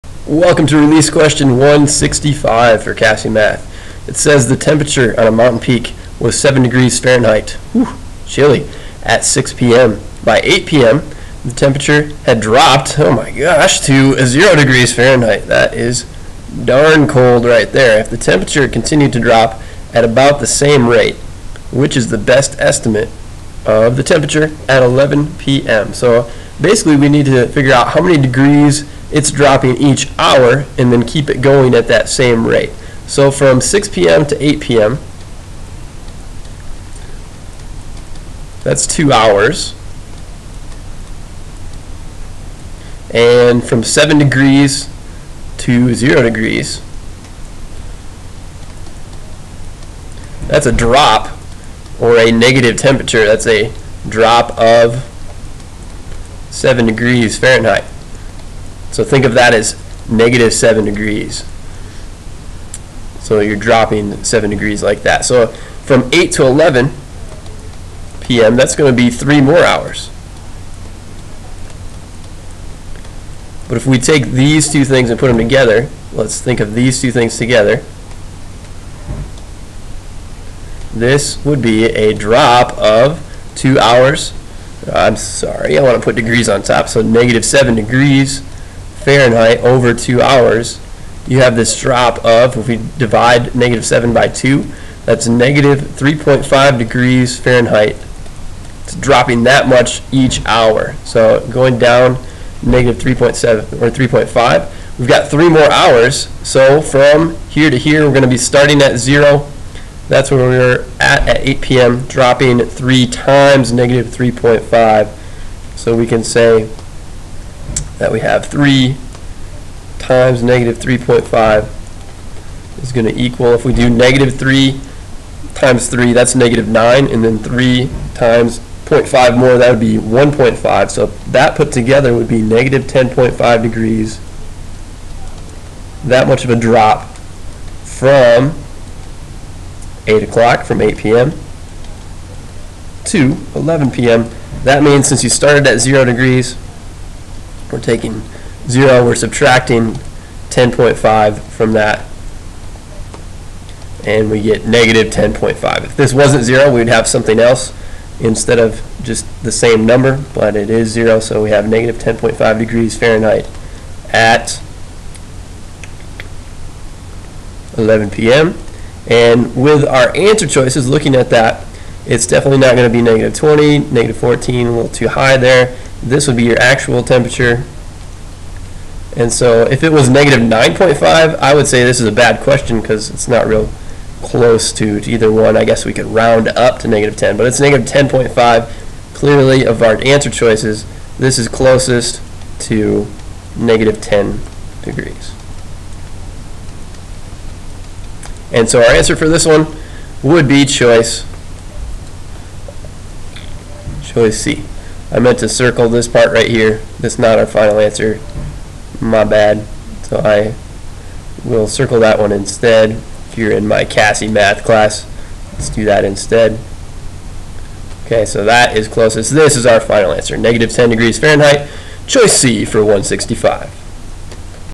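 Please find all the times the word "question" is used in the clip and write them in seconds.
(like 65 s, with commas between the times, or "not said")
1 s, 182 s.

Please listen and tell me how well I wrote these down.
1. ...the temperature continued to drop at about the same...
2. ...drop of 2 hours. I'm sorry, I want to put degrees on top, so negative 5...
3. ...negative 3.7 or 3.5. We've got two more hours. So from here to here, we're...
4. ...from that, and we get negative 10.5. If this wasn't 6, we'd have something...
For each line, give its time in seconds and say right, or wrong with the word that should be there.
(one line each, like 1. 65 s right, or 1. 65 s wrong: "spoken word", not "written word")
1. 18 s right
2. 82 s wrong: "7", not "5"
3. 102 s wrong: "three", not "two"
4. 151 s wrong: "0", not "6".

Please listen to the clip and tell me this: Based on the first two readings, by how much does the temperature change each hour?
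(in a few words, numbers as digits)
-3.5 degrees Fahrenheit.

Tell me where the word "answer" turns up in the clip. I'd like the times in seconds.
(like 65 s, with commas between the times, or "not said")
170 s, 190 s, 198 s, 207 s, 220 s.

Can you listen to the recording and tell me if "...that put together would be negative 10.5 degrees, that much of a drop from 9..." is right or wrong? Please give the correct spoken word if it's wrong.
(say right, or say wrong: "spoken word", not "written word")
wrong: "8", not "9".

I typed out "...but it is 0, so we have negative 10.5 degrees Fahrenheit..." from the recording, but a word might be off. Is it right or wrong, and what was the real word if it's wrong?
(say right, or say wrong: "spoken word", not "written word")
right.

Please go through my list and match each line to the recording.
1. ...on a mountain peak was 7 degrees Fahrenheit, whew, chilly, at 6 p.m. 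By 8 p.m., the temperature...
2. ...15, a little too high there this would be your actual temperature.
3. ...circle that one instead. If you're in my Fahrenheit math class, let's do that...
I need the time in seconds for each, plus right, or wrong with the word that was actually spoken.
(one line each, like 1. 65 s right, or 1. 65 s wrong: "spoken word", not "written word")
1. 5 s right
2. 174 s wrong: "14", not "15"
3. 211 s wrong: "CAHSEE", not "Fahrenheit".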